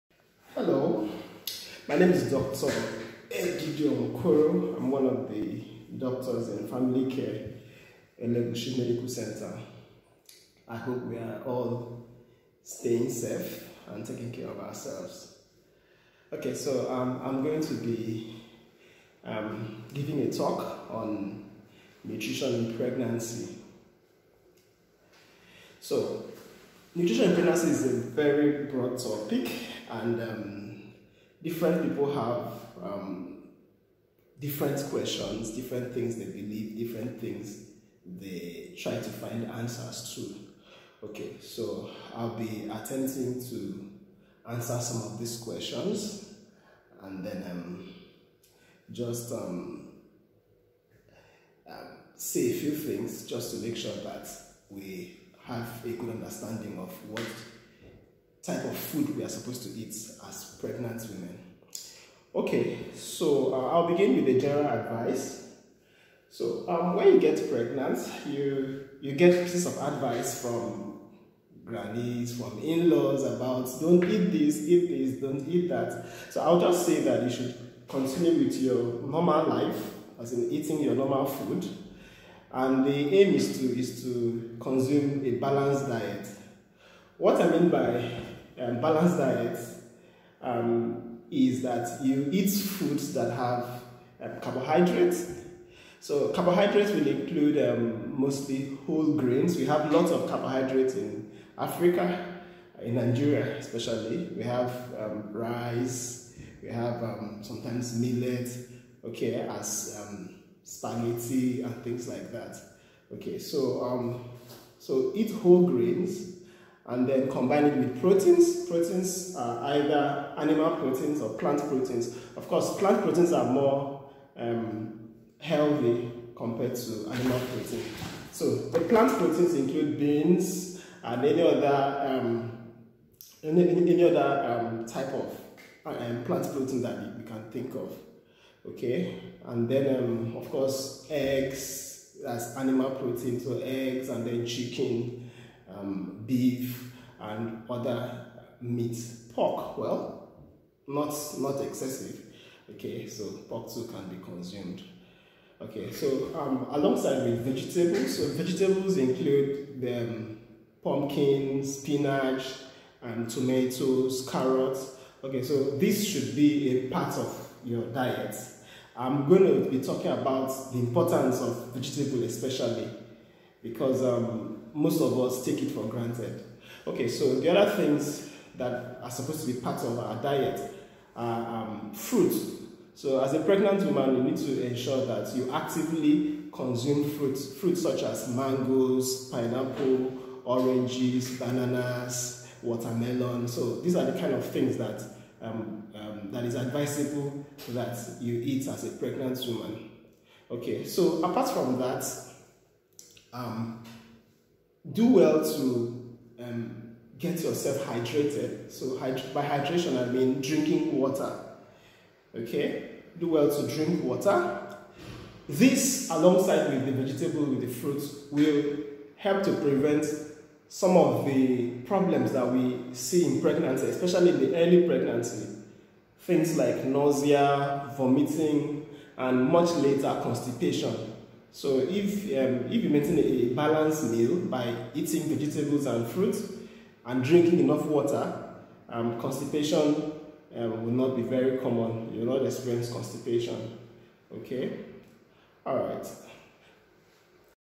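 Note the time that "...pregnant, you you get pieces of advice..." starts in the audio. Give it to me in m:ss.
1:07.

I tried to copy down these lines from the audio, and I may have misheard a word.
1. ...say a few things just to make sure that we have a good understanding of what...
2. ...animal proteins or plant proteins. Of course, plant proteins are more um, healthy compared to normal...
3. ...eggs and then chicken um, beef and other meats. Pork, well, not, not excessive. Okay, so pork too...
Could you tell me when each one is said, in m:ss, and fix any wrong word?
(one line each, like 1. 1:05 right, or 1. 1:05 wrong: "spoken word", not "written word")
1. 0:52 right
2. 2:00 wrong: "animal", not "normal"
3. 2:23 right.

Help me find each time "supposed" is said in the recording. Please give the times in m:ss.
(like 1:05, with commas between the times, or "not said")
0:59, 2:59.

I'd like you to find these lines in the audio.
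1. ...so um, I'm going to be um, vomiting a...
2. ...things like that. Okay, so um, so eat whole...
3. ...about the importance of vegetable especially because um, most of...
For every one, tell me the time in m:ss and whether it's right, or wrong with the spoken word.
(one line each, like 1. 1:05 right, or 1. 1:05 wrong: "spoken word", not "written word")
1. 0:16 wrong: "giving", not "vomiting"
2. 1:51 right
3. 2:50 right.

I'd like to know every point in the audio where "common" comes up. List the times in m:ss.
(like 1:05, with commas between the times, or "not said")
4:01.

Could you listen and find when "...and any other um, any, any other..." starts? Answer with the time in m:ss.
2:11.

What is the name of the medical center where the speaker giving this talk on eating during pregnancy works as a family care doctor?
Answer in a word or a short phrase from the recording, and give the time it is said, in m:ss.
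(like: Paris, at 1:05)
Elegushi Medical Center, at 0:08.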